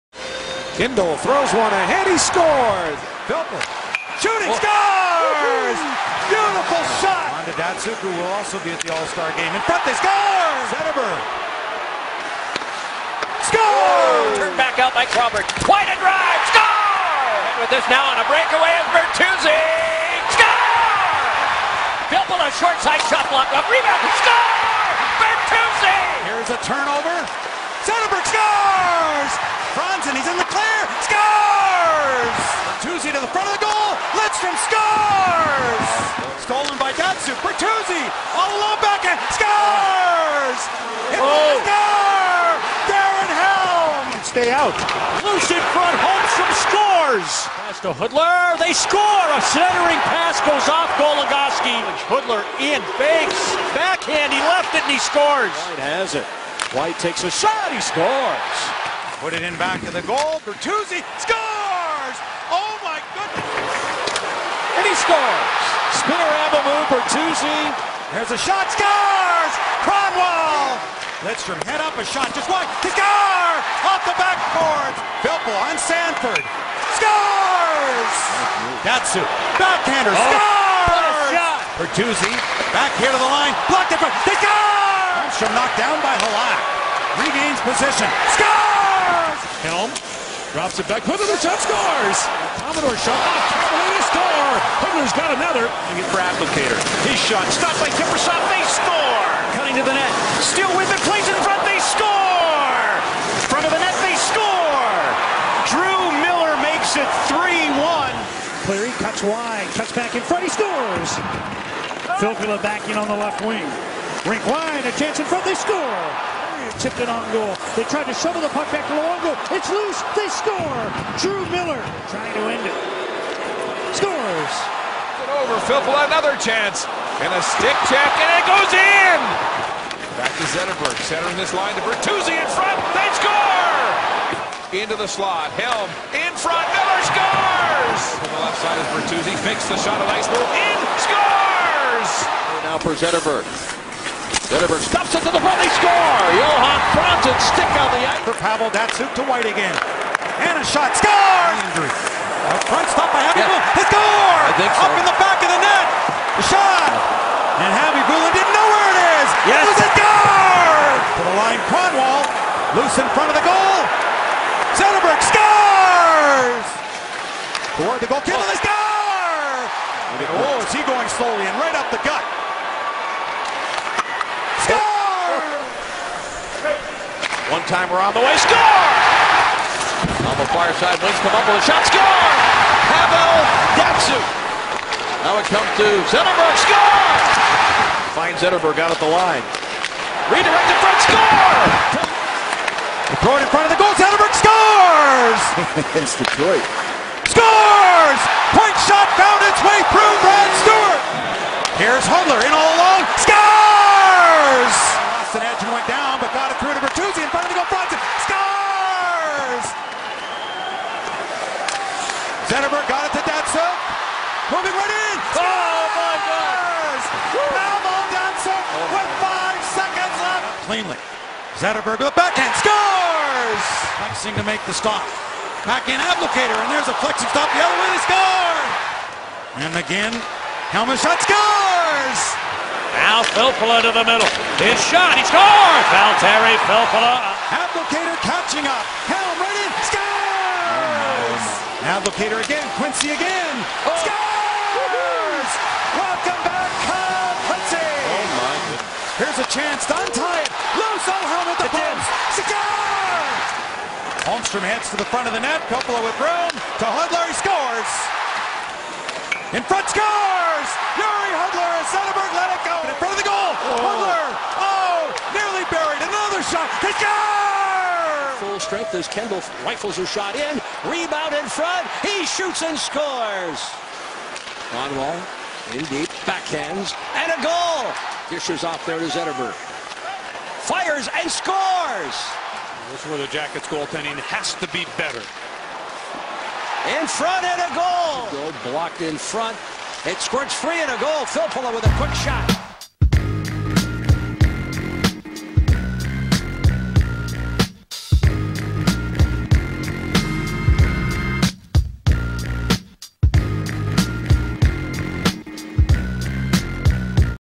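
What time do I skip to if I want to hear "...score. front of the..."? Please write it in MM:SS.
01:41.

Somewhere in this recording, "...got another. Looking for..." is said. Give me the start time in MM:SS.
01:35.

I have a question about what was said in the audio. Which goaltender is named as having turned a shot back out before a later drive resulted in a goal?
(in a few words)
Crawford.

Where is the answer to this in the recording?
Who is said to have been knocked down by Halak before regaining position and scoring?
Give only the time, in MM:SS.
01:24.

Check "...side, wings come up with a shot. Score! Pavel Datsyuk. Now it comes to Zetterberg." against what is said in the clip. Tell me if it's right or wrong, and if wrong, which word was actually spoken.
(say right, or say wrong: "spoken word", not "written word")
right.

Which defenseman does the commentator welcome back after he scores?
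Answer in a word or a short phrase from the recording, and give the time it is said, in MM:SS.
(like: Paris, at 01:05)
Kyle Quincey, at 04:06.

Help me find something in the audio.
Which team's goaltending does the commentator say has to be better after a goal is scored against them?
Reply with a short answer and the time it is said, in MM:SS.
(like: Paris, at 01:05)
the Jackets, at 04:43.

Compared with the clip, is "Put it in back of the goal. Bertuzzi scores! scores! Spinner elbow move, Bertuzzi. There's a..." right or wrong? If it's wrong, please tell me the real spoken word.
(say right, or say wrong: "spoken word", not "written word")
right.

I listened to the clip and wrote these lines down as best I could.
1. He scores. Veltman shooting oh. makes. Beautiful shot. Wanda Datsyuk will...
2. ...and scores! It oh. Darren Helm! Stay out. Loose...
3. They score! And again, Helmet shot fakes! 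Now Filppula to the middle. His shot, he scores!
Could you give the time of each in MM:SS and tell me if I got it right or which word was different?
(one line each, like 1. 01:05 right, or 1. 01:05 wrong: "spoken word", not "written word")
1. 00:02 wrong: "scores", not "makes"
2. 00:39 right
3. 03:47 wrong: "scores", not "fakes".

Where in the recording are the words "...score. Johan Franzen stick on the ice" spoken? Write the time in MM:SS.
02:25.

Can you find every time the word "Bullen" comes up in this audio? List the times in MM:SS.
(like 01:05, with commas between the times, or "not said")
02:33, 02:38.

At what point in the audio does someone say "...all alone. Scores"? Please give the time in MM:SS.
03:22.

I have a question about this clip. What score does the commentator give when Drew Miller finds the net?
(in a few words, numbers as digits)
3-1.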